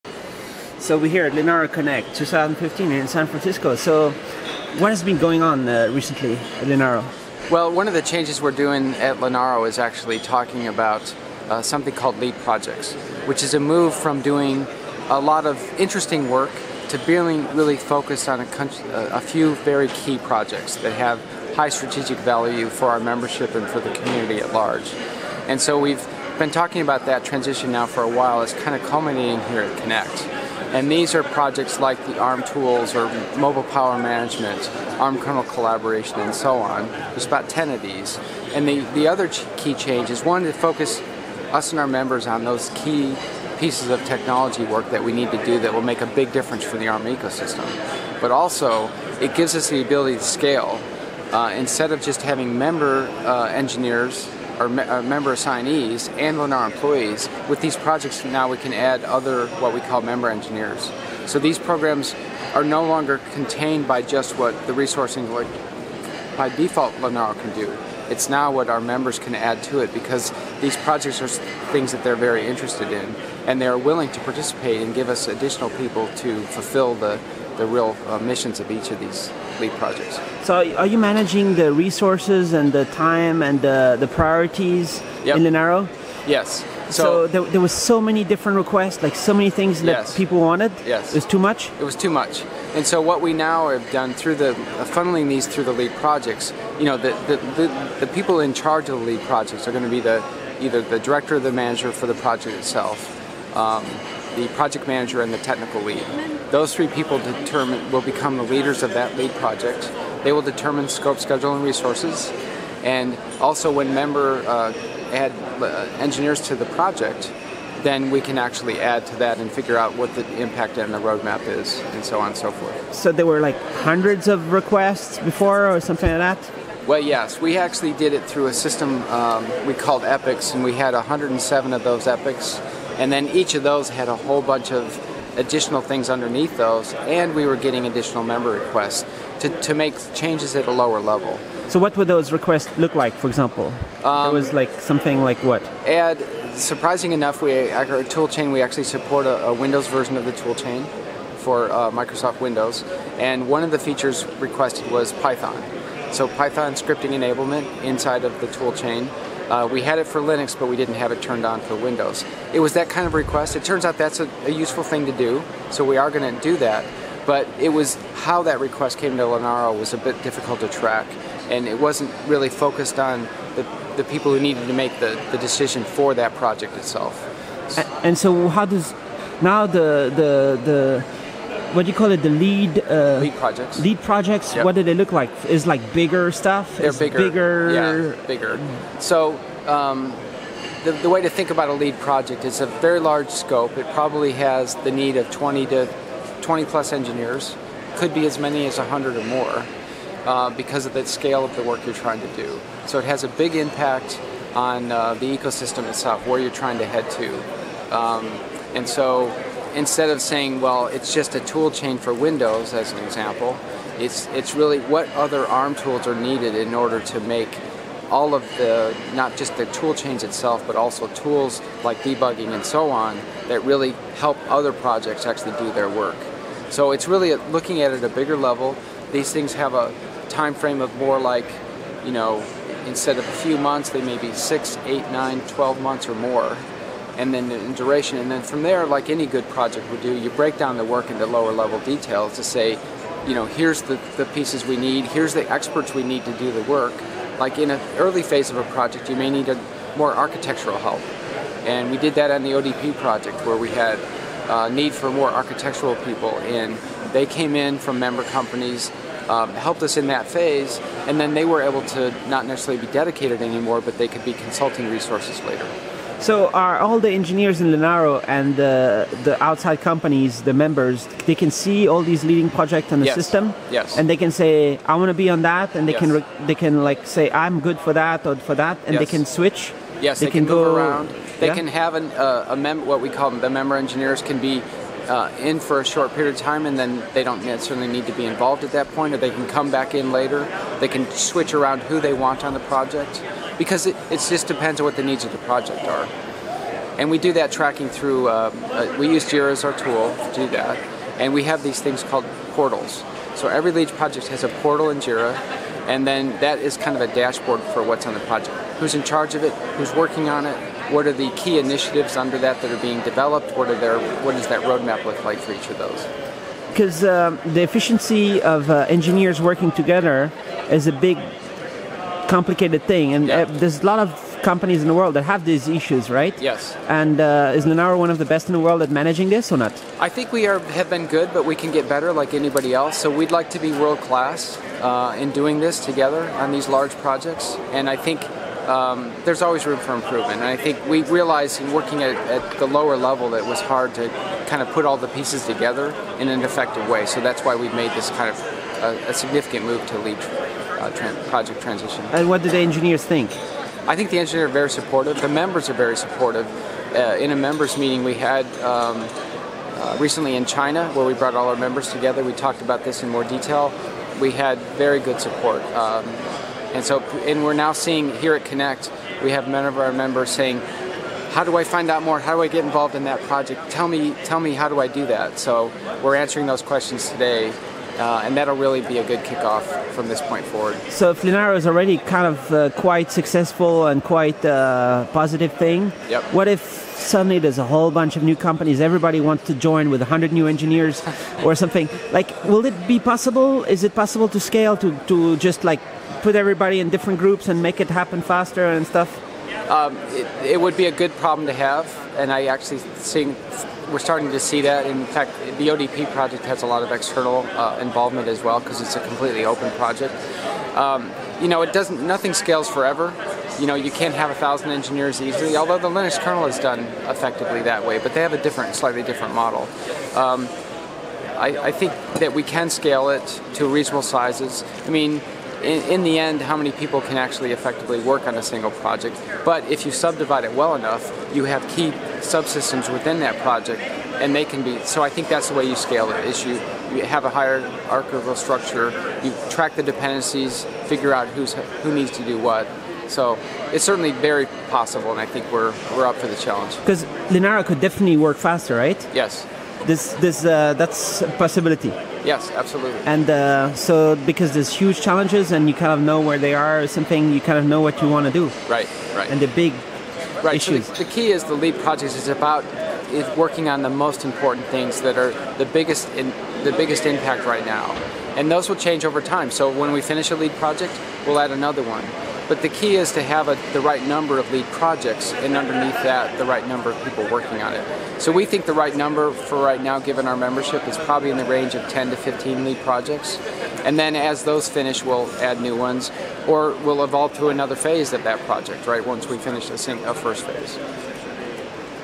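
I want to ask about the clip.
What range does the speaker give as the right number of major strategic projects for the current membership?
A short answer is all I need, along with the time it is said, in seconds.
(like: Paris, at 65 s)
10 to 15, at 481 s.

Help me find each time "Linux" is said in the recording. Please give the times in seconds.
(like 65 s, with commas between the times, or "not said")
160 s, 415 s.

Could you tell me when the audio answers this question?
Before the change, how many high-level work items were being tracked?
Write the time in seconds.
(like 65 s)
130 s.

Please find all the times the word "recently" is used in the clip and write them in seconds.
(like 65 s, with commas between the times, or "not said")
5 s, 359 s.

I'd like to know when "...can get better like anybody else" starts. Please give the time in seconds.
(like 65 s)
331 s.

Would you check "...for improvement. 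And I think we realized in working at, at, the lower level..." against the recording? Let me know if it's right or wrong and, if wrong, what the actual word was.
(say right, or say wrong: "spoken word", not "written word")
right.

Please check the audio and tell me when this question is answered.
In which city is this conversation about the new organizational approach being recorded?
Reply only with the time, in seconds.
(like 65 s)
3 s.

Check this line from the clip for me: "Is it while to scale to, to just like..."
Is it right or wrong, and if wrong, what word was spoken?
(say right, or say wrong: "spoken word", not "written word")
wrong: "possible", not "while".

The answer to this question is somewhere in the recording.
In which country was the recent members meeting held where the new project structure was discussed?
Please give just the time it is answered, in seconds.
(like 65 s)
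360 s.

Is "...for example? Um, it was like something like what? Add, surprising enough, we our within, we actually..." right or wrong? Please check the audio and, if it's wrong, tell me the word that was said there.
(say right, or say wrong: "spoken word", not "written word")
wrong: "toolchain", not "within".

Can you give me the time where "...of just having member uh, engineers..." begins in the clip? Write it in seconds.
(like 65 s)
51 s.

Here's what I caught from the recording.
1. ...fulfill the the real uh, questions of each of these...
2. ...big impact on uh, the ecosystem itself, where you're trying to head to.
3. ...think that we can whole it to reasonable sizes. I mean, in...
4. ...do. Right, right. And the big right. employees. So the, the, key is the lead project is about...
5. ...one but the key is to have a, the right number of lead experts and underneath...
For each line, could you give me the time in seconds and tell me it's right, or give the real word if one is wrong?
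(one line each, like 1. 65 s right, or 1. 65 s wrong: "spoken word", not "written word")
1. 76 s wrong: "missions", not "questions"
2. 203 s right
3. 421 s wrong: "scale", not "whole"
4. 458 s wrong: "issues", not "employees"
5. 471 s wrong: "projects", not "experts".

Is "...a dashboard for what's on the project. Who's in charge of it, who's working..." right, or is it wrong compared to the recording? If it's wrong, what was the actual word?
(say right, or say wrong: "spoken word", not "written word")
right.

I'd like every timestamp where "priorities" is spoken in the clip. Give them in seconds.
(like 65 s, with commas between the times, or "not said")
84 s.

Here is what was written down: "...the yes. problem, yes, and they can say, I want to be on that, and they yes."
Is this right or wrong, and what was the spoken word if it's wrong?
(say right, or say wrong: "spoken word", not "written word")
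wrong: "system", not "problem".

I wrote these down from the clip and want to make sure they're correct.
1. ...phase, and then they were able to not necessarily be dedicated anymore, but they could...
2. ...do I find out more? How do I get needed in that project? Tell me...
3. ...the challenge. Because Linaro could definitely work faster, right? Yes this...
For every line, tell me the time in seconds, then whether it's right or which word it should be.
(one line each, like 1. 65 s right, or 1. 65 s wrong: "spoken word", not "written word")
1. 260 s right
2. 371 s wrong: "involved", not "needed"
3. 446 s right.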